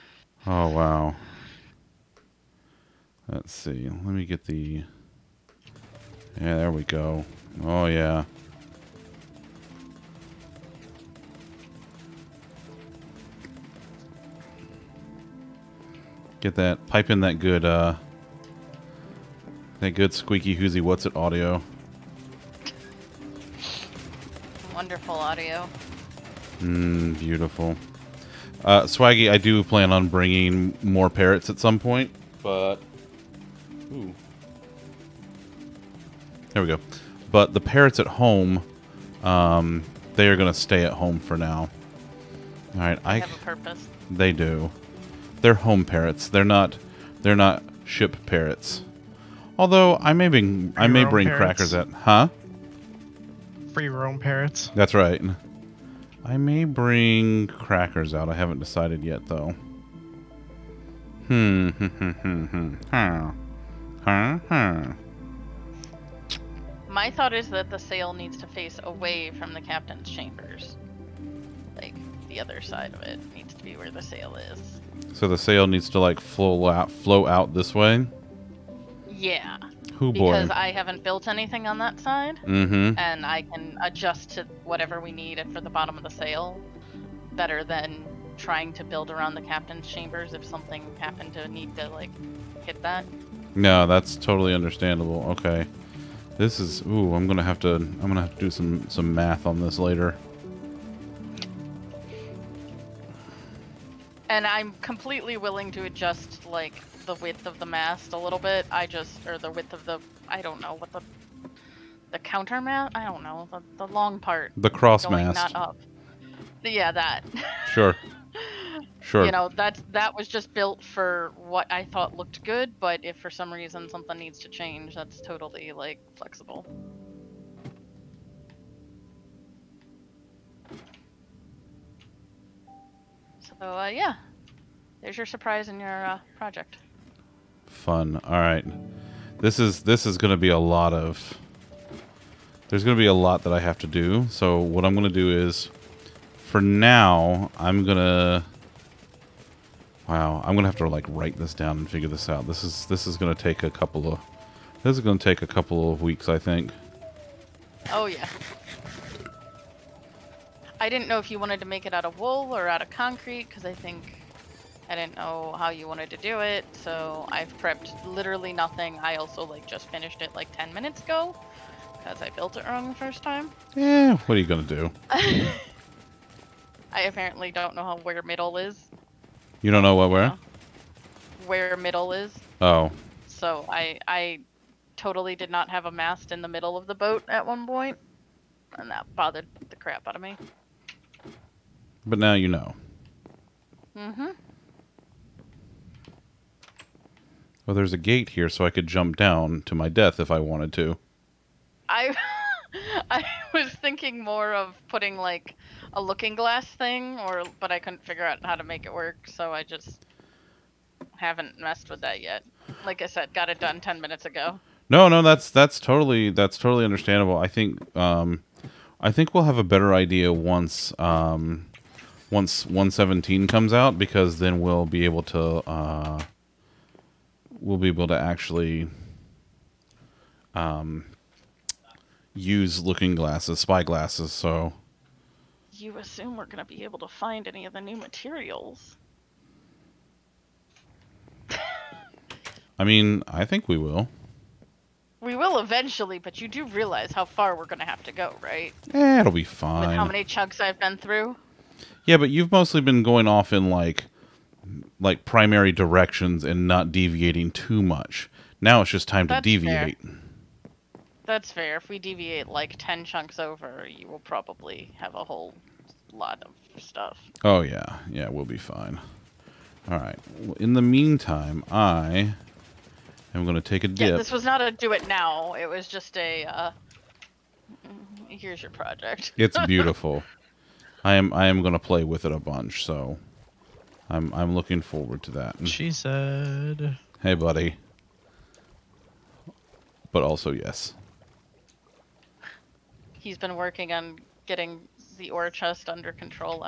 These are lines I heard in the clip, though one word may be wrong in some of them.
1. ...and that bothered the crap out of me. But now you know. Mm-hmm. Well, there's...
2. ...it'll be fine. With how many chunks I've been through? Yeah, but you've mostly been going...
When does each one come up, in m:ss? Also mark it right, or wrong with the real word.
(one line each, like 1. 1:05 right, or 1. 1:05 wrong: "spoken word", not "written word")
1. 3:08 right
2. 4:09 right.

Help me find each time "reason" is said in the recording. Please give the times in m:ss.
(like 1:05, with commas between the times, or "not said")
2:03.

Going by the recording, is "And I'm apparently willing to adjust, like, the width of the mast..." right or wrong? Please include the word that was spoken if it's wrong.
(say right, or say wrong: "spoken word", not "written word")
wrong: "completely", not "apparently".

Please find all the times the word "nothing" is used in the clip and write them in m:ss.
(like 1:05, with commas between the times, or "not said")
2:48.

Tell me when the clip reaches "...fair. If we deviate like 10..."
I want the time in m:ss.
4:21.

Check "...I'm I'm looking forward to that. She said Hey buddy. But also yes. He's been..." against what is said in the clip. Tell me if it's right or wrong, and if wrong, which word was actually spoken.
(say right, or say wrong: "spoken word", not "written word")
right.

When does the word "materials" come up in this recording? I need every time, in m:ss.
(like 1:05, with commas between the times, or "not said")
3:57.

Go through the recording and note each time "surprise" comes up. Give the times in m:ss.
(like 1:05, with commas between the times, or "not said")
2:15.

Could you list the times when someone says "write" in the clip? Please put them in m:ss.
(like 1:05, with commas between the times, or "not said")
2:31.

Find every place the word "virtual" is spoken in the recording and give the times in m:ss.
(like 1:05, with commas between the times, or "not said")
not said.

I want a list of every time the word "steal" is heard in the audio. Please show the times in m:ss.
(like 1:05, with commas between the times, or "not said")
not said.